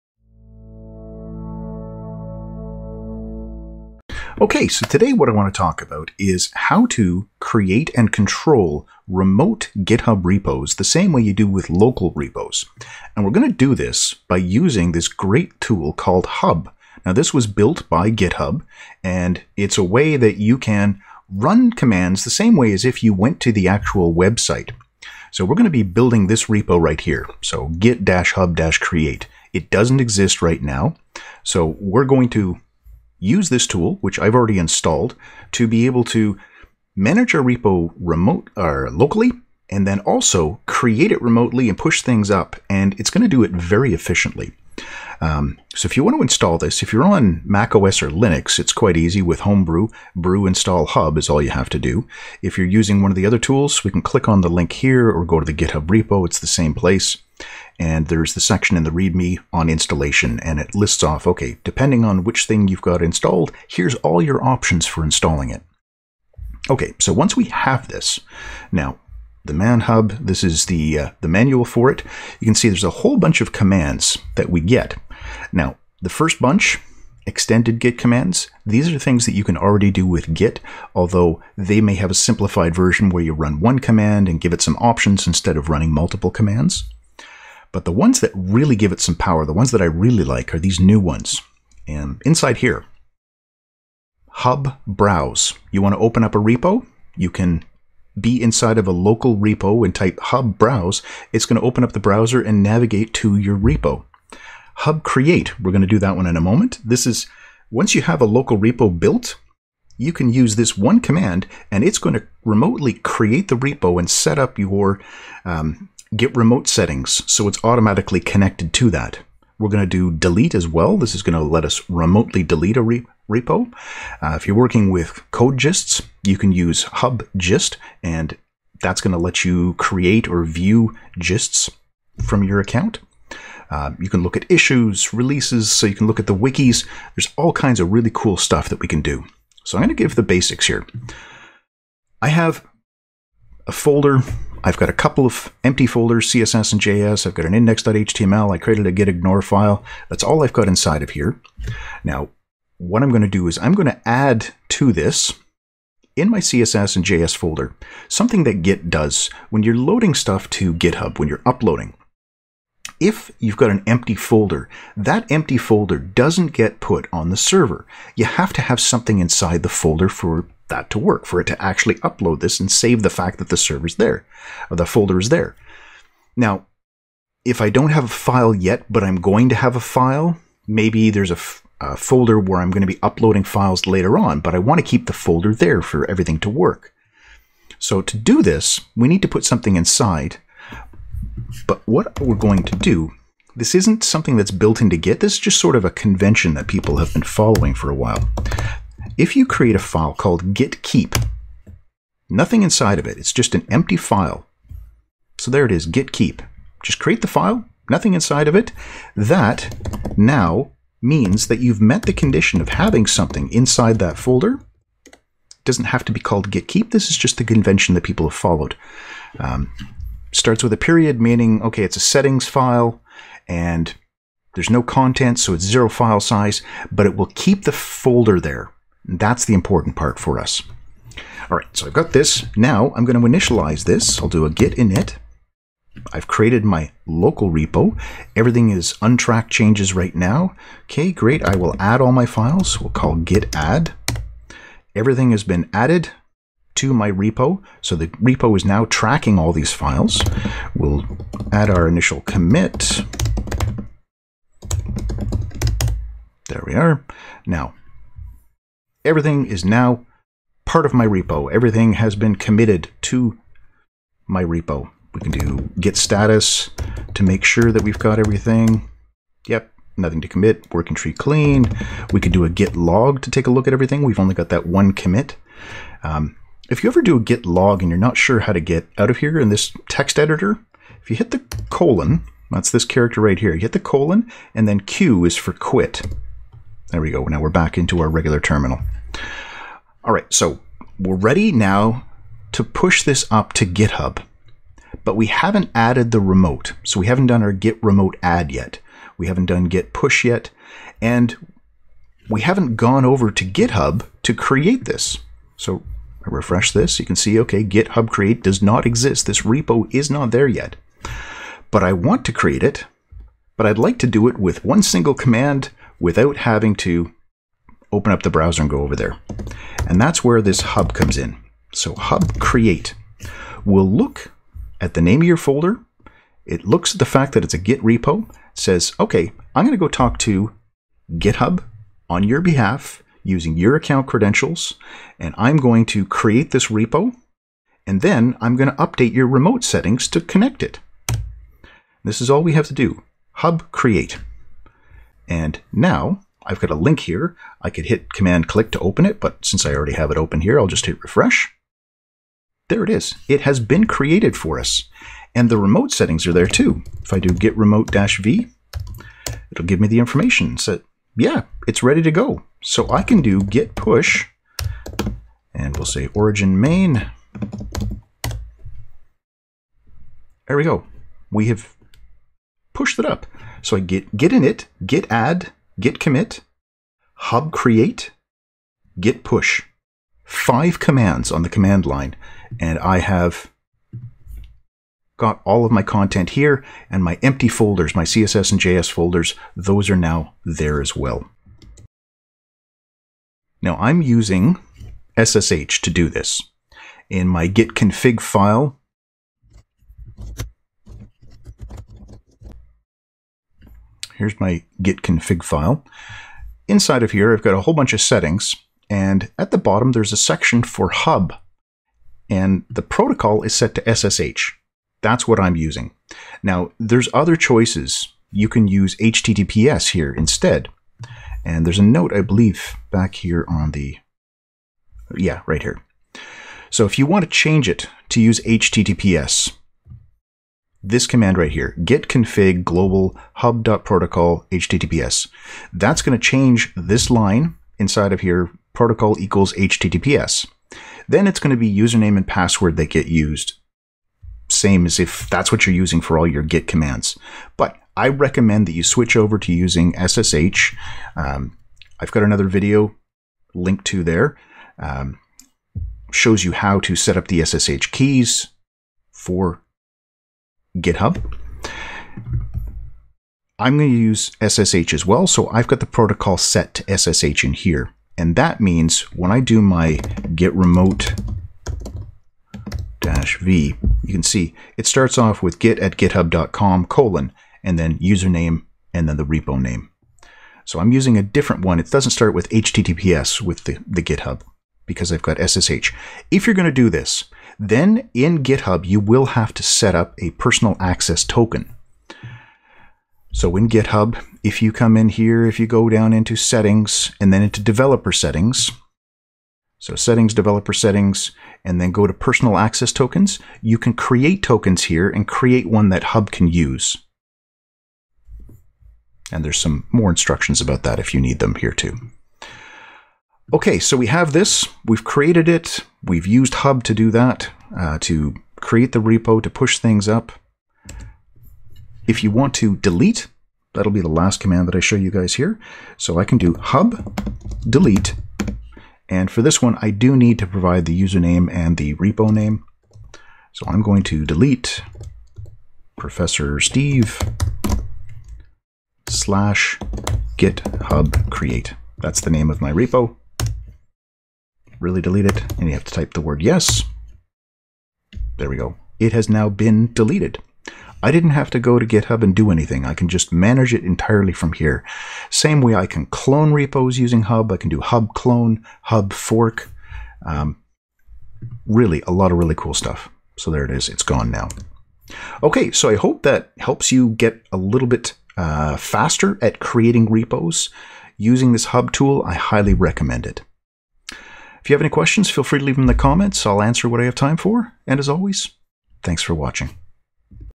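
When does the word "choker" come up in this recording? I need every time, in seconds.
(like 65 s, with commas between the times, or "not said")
not said.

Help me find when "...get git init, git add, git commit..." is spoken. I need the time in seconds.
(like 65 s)
373 s.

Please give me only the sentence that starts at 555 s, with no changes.
Same way I can clone repos using Hub.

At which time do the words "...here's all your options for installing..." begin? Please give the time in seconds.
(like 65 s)
63 s.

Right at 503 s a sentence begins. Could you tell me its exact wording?
You can create tokens here and create one that Hub can use.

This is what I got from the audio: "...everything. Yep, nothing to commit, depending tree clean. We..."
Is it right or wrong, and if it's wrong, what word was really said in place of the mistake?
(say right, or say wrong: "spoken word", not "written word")
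wrong: "working", not "depending".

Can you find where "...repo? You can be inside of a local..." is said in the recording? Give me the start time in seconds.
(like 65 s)
96 s.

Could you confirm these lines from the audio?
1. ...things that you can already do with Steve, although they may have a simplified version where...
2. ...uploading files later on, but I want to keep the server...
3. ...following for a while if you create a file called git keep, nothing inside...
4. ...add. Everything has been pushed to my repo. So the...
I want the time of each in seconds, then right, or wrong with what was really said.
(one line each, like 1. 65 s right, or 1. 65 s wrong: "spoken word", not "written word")
1. 78 s wrong: "Git", not "Steve"
2. 183 s wrong: "folder", not "server"
3. 197 s right
4. 243 s wrong: "added", not "pushed".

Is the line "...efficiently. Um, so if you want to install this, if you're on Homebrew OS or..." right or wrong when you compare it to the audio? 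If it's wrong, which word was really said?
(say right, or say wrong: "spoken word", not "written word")
wrong: "Mac", not "Homebrew".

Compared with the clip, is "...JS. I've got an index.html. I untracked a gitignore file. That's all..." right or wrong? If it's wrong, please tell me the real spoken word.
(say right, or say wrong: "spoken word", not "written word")
wrong: "created", not "untracked".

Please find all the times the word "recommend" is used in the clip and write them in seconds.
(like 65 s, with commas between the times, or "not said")
448 s, 572 s.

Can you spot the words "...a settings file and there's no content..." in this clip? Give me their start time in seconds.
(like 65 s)
221 s.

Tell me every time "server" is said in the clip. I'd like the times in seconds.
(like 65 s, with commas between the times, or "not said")
167 s, 173 s.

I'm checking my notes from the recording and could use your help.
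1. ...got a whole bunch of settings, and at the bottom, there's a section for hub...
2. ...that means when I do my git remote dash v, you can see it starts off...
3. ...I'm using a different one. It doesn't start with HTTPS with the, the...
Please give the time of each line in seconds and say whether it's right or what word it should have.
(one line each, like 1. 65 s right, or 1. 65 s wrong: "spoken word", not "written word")
1. 407 s right
2. 468 s right
3. 480 s right.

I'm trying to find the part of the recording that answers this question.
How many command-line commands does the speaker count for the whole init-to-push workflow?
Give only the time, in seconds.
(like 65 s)
380 s.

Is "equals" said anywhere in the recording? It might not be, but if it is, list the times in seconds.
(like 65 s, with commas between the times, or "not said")
439 s.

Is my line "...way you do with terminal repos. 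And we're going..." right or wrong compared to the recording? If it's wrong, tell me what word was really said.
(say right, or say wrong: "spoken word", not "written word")
wrong: "local", not "terminal".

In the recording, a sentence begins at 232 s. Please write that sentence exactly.
Now I'm going to initialize this.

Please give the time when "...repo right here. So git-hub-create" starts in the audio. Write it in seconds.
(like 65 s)
26 s.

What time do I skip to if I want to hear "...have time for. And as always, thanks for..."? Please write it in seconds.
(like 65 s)
577 s.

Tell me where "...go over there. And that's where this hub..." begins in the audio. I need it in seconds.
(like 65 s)
318 s.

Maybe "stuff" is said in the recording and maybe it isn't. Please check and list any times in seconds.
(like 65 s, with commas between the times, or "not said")
138 s, 160 s, 562 s.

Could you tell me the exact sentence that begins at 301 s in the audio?
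And we haven't gone over to GitHub to create this.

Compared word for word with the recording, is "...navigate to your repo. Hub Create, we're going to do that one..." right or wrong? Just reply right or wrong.
right.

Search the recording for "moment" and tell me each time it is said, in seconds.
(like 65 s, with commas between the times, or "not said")
106 s.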